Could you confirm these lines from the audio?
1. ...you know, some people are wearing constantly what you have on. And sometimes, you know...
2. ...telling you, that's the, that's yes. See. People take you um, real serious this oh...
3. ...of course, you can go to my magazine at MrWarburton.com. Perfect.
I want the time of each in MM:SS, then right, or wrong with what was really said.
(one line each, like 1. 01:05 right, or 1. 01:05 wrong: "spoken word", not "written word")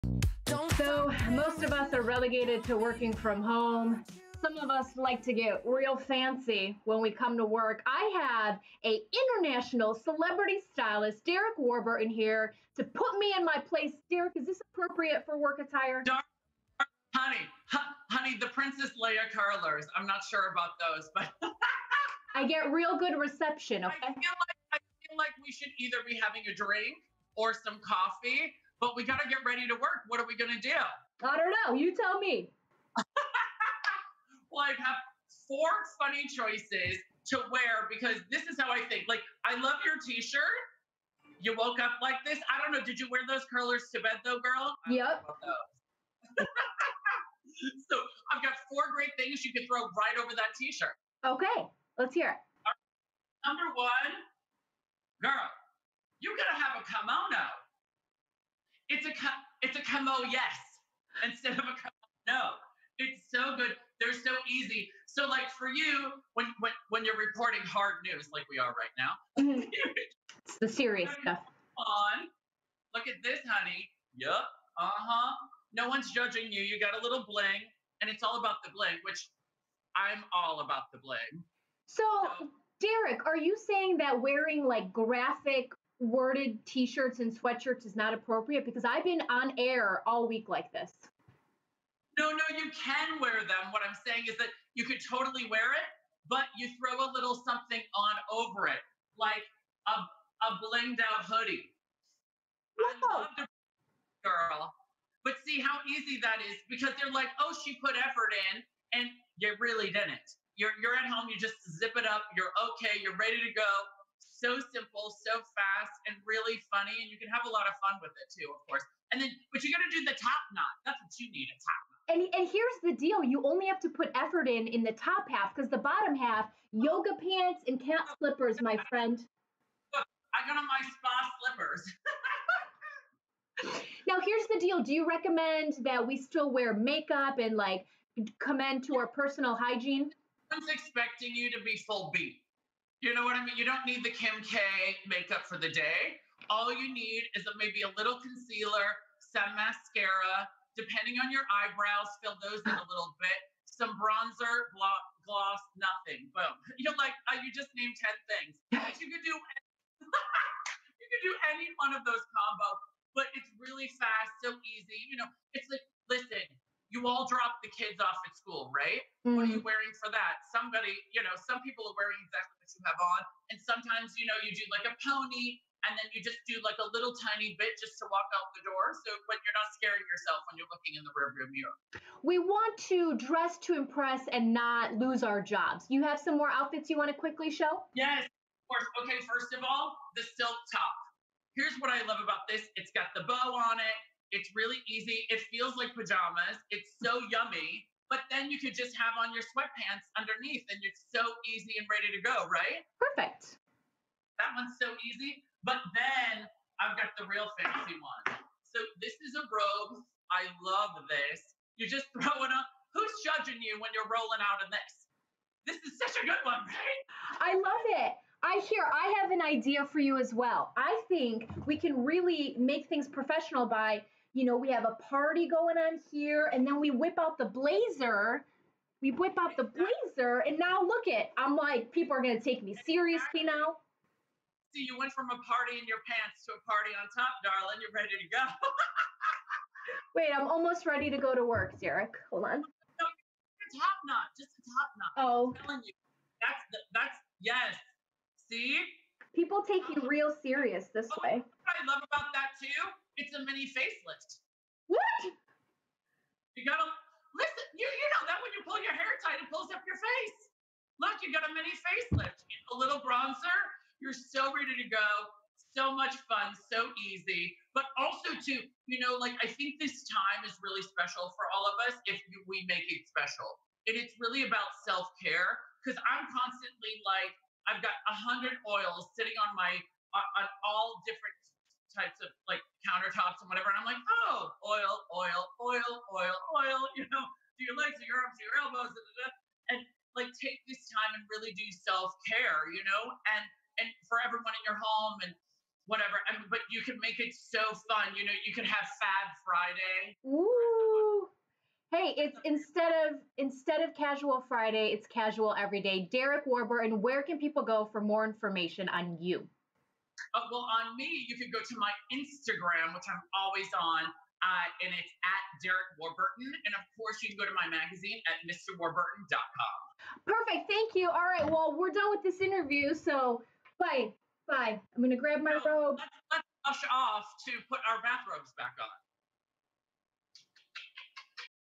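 1. 02:51 wrong: "exactly", not "constantly"
2. 04:05 right
3. 05:16 right.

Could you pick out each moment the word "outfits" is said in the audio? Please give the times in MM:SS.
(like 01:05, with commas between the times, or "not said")
03:06.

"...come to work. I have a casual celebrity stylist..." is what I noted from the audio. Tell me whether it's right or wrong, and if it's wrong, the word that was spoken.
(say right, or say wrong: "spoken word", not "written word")
wrong: "international", not "casual".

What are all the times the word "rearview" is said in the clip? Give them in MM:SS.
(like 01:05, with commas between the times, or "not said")
03:01.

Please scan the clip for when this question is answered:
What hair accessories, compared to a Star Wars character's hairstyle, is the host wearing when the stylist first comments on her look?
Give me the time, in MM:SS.
00:18.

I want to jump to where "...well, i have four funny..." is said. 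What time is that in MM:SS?
00:34.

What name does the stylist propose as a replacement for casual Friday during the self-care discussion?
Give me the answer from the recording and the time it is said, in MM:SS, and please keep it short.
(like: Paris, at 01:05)
Fab Friday, at 04:59.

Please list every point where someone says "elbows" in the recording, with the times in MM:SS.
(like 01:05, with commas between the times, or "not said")
04:48.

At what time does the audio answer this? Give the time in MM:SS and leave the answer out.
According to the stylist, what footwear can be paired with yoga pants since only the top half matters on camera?
02:07.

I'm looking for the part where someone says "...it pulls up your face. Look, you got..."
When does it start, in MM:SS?
04:19.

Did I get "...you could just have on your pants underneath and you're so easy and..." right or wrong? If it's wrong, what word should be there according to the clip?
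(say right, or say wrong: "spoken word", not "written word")
wrong: "sweatpants", not "pants".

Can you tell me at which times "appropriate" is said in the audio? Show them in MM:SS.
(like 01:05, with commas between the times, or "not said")
00:14, 01:28.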